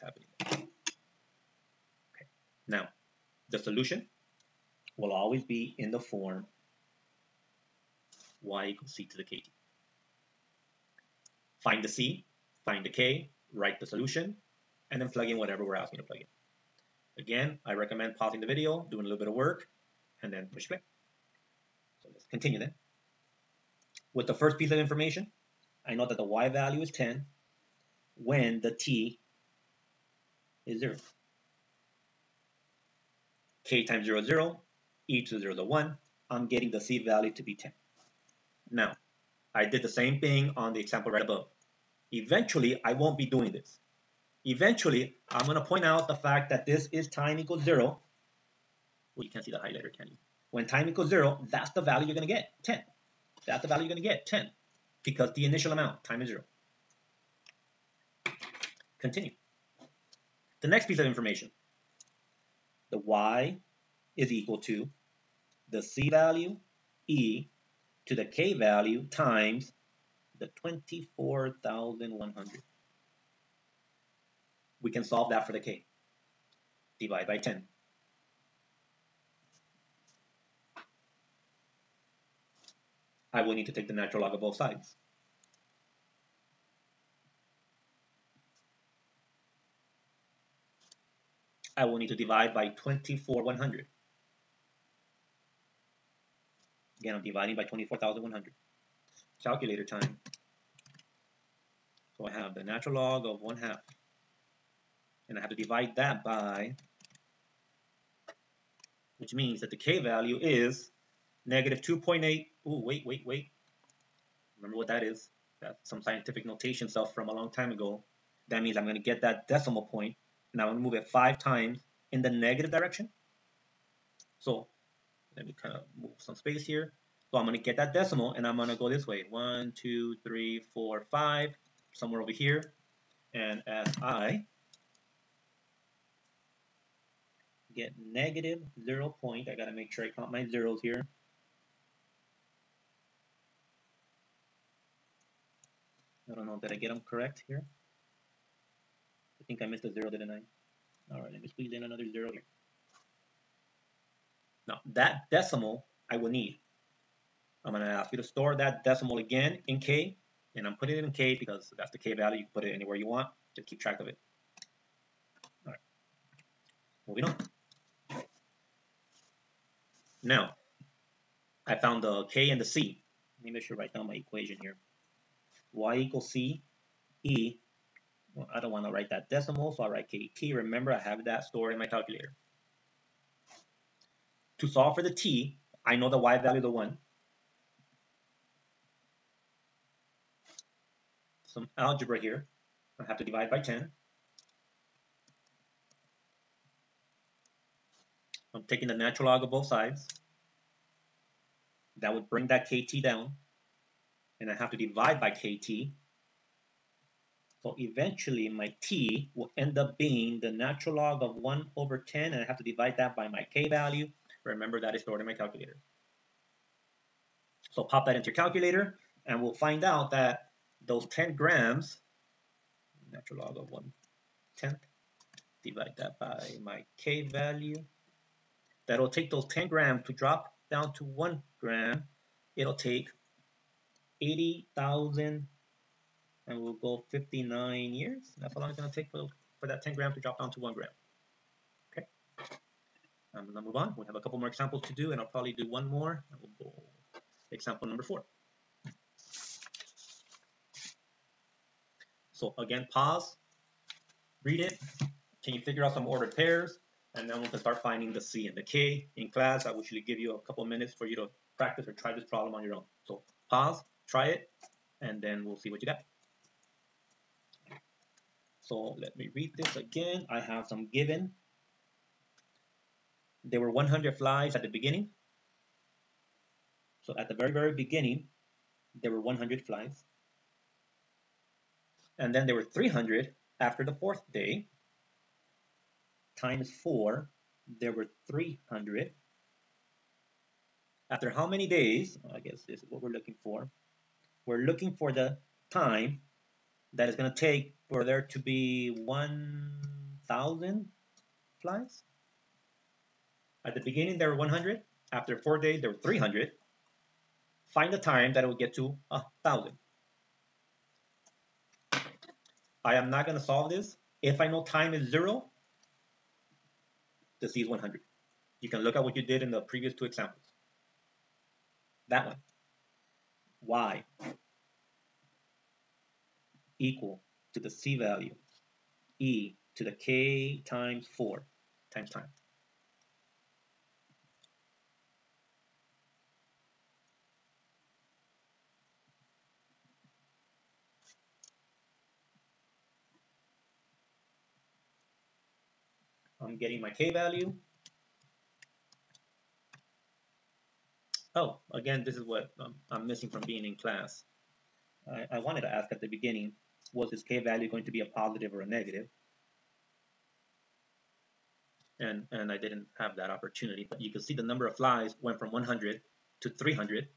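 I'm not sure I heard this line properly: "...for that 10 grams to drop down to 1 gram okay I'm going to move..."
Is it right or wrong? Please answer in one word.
right.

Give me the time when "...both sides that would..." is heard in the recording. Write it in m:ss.
3:19.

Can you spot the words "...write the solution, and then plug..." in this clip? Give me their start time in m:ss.
0:13.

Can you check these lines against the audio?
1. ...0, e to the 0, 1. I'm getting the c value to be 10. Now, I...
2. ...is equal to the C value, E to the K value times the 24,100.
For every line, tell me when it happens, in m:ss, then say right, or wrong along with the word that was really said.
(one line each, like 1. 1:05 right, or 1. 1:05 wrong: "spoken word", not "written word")
1. 0:34 right
2. 1:04 right.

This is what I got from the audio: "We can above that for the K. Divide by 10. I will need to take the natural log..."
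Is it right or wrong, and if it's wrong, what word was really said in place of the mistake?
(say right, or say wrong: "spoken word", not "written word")
wrong: "solve", not "above".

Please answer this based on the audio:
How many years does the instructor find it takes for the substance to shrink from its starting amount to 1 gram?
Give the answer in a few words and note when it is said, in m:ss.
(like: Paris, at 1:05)
80,059, at 3:54.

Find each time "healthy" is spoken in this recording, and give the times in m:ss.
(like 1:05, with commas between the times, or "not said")
not said.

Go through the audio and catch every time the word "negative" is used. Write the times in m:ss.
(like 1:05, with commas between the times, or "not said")
1:51, 2:02, 2:18, 5:58.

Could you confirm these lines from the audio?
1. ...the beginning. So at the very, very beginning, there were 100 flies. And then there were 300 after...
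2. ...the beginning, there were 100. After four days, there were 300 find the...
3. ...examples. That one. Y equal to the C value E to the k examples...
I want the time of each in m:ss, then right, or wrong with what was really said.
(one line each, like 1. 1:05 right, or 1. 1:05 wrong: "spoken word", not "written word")
1. 4:34 right
2. 5:03 right
3. 5:20 wrong: "times", not "examples".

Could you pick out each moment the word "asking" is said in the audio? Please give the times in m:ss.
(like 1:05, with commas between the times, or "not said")
0:15.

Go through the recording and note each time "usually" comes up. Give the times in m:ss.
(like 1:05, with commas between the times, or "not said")
4:19.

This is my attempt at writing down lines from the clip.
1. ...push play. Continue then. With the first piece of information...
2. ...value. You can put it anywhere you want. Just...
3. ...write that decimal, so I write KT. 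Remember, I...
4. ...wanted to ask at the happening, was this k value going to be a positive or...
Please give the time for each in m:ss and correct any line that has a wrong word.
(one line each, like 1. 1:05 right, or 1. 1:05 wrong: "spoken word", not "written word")
1. 0:20 right
2. 2:42 right
3. 2:58 right
4. 5:55 wrong: "beginning", not "happening".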